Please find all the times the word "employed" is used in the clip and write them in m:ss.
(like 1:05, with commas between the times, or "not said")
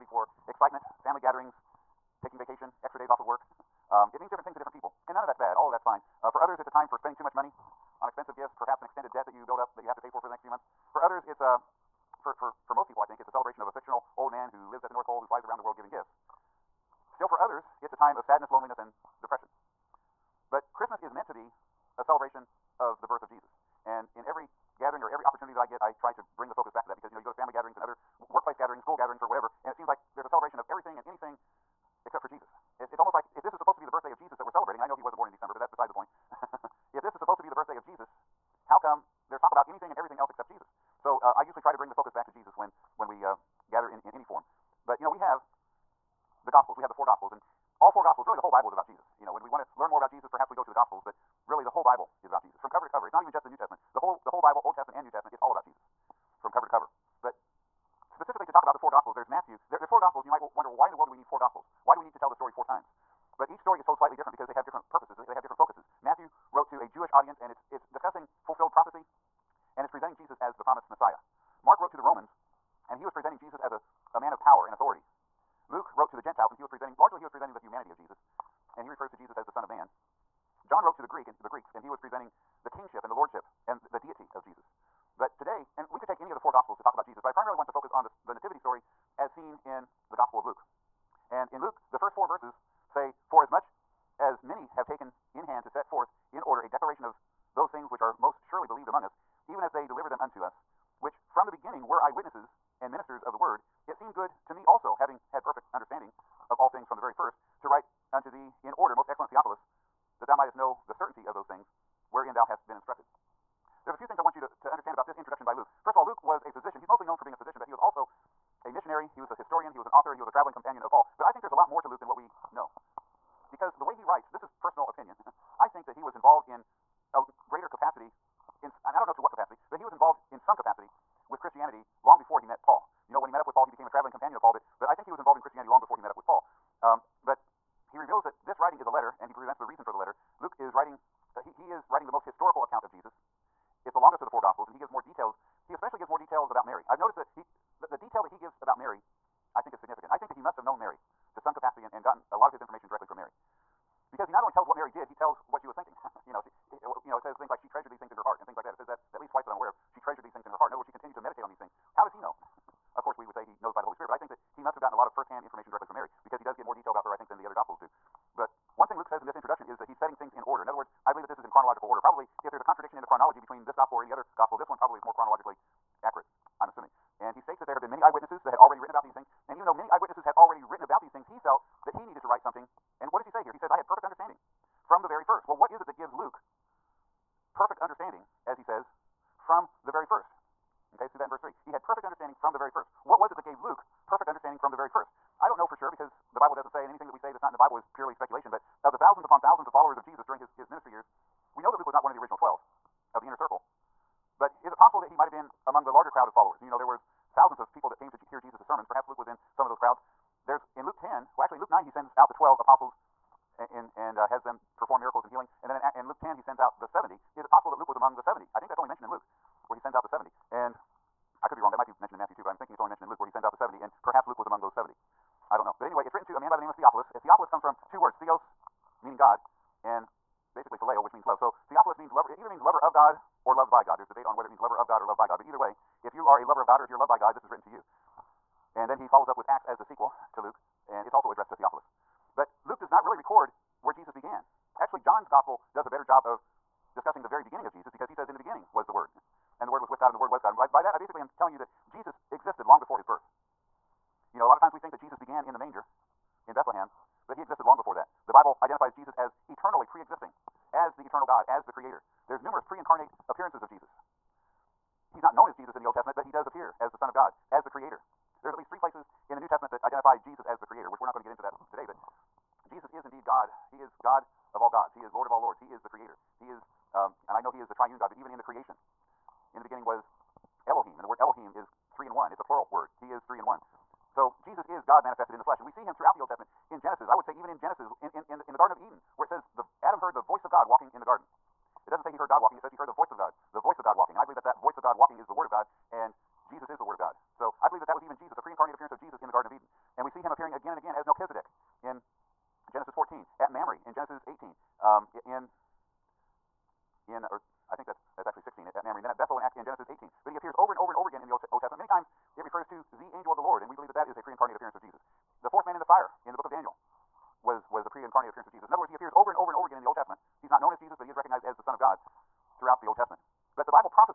not said.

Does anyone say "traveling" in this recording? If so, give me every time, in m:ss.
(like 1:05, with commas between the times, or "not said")
2:00, 2:13.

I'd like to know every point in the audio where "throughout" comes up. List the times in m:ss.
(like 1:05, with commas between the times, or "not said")
4:45, 5:22.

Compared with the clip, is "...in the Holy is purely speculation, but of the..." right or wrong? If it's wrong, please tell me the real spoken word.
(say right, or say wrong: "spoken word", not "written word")
wrong: "Bible", not "Holy".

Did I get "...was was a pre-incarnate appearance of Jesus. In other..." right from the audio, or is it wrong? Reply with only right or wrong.
right.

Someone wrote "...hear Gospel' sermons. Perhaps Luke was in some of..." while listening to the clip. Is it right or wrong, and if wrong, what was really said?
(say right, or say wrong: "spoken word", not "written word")
wrong: "Jesus", not "Gospel".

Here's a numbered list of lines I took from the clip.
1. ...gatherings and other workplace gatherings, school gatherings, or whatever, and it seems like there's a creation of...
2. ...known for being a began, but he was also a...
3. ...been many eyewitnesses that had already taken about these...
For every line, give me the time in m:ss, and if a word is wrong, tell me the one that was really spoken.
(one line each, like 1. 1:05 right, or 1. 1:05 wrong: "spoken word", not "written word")
1. 0:27 wrong: "celebration", not "creation"
2. 1:57 wrong: "physician", not "began"
3. 2:57 wrong: "written", not "taken".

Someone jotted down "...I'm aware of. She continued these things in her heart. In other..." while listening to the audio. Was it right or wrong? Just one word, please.
wrong.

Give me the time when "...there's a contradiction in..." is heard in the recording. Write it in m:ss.
2:52.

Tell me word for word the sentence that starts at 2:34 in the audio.
Because he not only tells what Mary did, he tells what she was thinking.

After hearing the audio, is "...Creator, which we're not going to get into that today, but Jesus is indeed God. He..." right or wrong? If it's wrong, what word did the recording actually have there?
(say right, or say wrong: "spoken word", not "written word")
right.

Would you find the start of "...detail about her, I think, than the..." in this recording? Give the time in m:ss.
2:46.